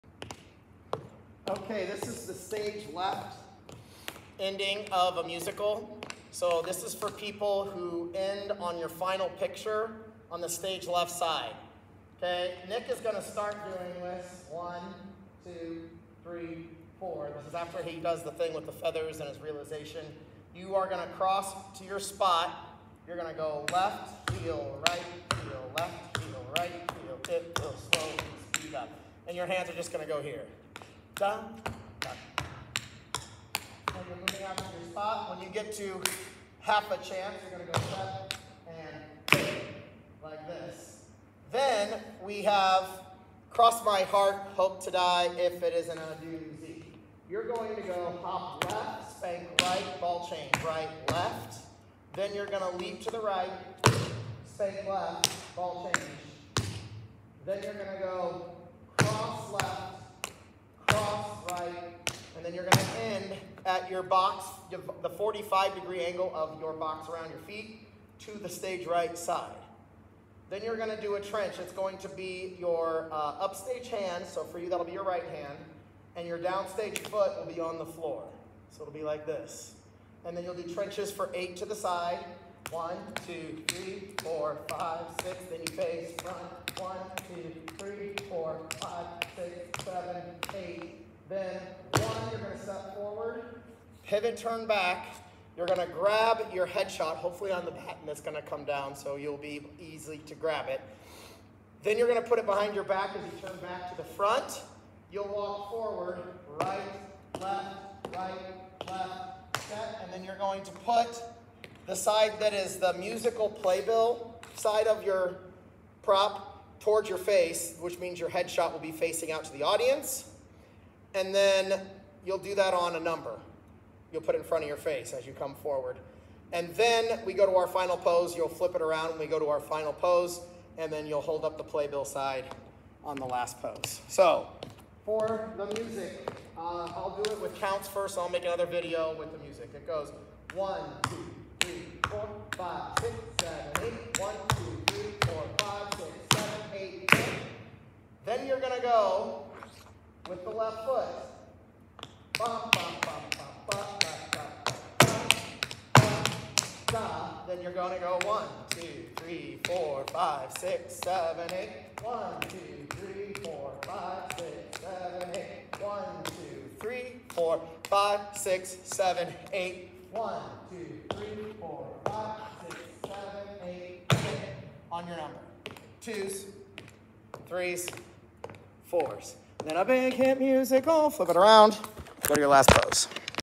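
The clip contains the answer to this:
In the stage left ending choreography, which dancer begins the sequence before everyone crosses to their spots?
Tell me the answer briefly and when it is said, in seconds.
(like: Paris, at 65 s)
Nick, at 12 s.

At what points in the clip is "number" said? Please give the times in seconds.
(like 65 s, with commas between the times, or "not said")
122 s, 175 s.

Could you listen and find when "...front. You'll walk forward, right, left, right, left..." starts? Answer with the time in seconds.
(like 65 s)
104 s.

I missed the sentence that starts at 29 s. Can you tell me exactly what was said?
And your hands are just gonna go here.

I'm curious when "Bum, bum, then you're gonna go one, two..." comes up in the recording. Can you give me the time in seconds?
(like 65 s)
152 s.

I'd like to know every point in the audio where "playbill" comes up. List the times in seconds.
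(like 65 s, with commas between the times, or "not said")
113 s, 131 s.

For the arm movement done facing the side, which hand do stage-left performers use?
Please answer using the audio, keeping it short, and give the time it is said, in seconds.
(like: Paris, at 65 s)
Right hand, at 75 s.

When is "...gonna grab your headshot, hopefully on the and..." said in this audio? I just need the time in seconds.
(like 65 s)
95 s.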